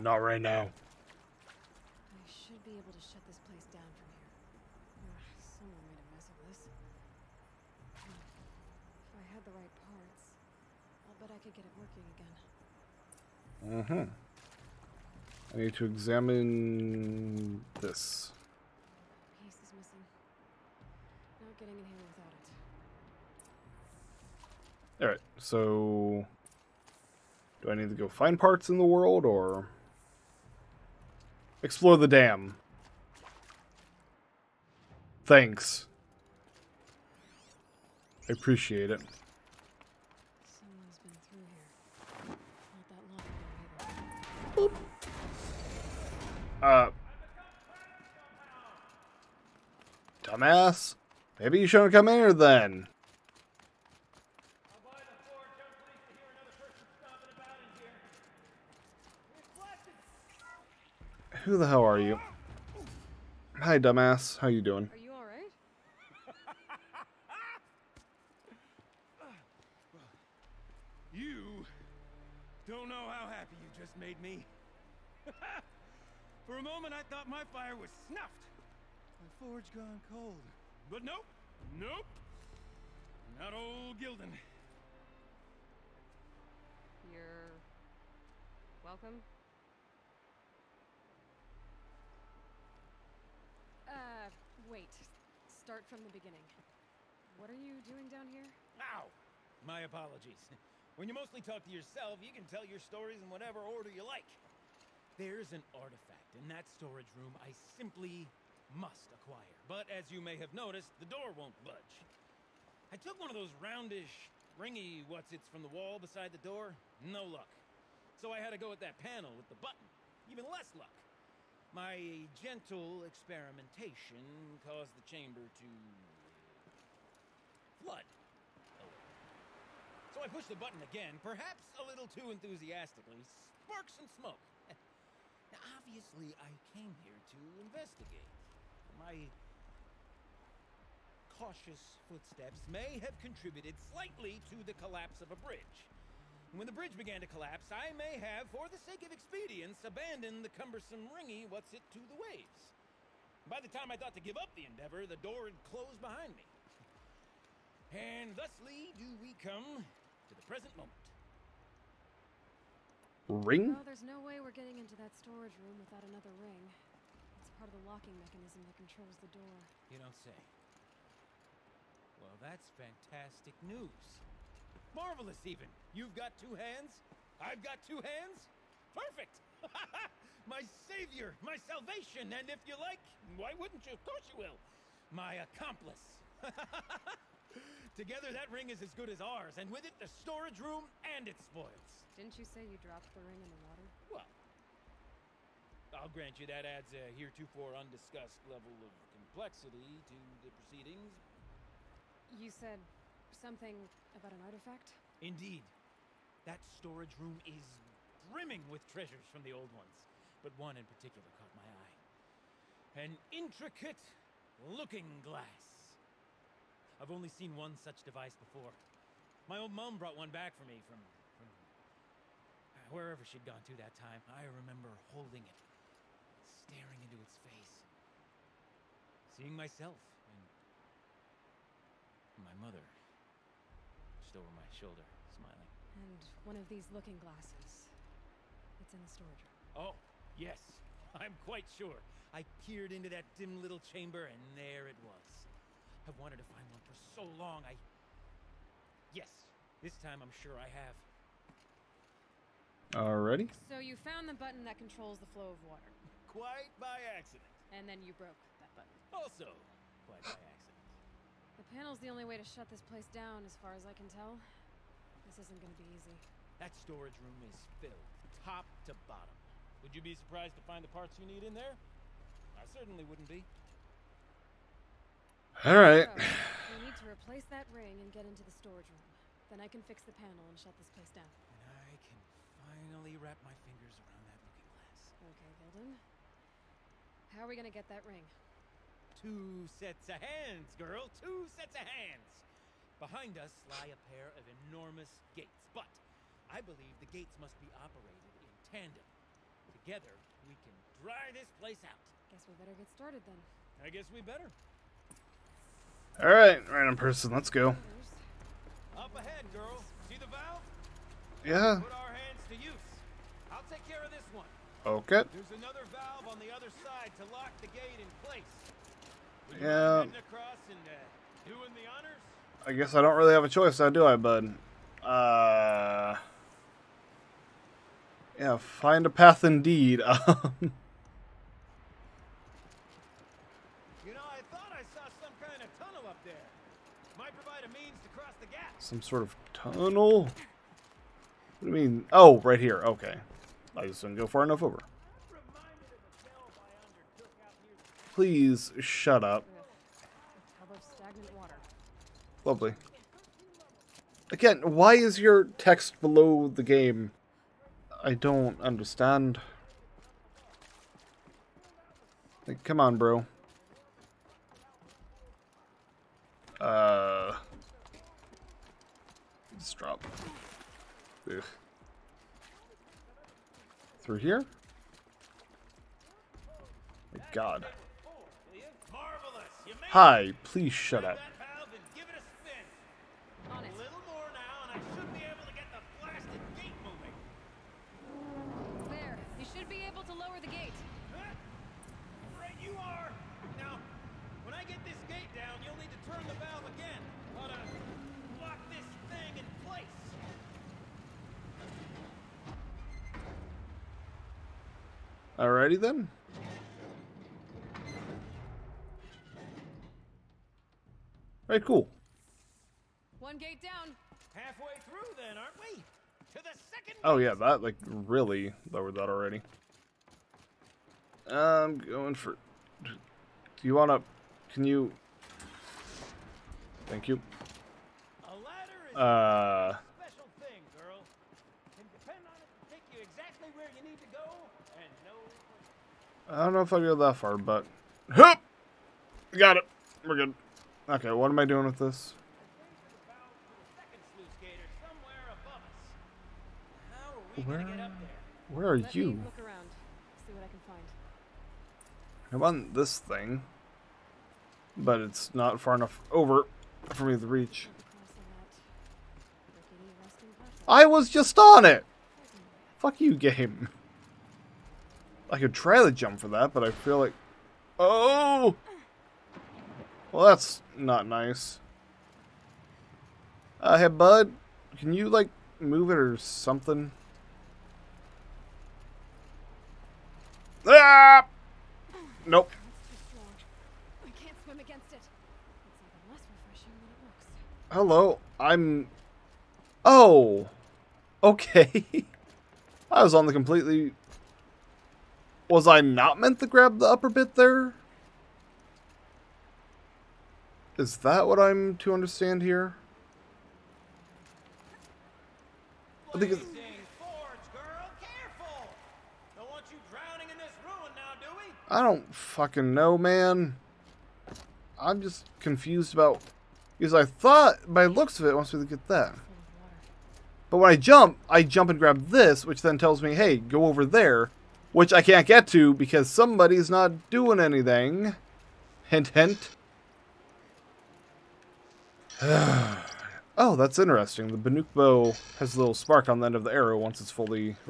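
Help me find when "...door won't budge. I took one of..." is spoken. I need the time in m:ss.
1:51.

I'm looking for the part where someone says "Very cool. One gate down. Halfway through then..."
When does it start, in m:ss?
6:51.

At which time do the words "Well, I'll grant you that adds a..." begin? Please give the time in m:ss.
3:14.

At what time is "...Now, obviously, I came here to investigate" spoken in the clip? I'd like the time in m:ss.
2:15.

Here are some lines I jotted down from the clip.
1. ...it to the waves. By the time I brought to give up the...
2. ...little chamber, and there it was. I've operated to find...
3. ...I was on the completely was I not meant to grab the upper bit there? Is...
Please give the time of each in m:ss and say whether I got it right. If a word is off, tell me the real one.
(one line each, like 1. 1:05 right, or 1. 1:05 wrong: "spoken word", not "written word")
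1. 2:31 wrong: "thought", not "brought"
2. 4:03 wrong: "wanted", not "operated"
3. 8:12 right.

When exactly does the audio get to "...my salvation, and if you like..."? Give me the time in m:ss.
3:01.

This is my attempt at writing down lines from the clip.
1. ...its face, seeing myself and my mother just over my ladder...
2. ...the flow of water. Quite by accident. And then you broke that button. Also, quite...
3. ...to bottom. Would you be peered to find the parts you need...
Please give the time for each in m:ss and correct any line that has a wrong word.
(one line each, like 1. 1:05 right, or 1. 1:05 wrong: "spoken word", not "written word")
1. 3:47 wrong: "shoulder", not "ladder"
2. 4:15 right
3. 4:28 wrong: "surprised", not "peered".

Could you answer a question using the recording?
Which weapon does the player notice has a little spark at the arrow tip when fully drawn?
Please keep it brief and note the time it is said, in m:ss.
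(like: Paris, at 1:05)
The Banuk bow, at 8:54.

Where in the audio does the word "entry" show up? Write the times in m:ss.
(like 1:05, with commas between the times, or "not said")
not said.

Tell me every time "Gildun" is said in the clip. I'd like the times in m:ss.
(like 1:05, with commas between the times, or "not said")
1:23, 4:45.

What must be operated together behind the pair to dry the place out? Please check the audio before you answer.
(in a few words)
A pair of enormous gates.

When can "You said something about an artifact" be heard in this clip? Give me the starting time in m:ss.
3:22.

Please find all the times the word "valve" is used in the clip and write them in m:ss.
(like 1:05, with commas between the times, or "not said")
5:10, 5:15.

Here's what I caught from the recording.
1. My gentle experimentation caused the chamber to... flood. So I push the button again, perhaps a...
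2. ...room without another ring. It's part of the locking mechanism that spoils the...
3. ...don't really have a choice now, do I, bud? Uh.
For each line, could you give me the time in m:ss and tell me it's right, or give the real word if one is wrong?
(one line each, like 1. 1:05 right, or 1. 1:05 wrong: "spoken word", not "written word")
1. 2:01 right
2. 2:45 wrong: "controls", not "spoils"
3. 5:23 right.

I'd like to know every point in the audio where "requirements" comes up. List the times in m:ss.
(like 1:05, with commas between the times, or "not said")
not said.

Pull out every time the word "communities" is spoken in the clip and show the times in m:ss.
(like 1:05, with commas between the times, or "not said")
not said.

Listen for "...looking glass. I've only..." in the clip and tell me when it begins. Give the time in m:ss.
3:34.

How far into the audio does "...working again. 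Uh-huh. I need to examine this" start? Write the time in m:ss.
0:13.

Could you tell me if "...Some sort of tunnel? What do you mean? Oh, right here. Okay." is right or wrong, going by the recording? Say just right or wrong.
right.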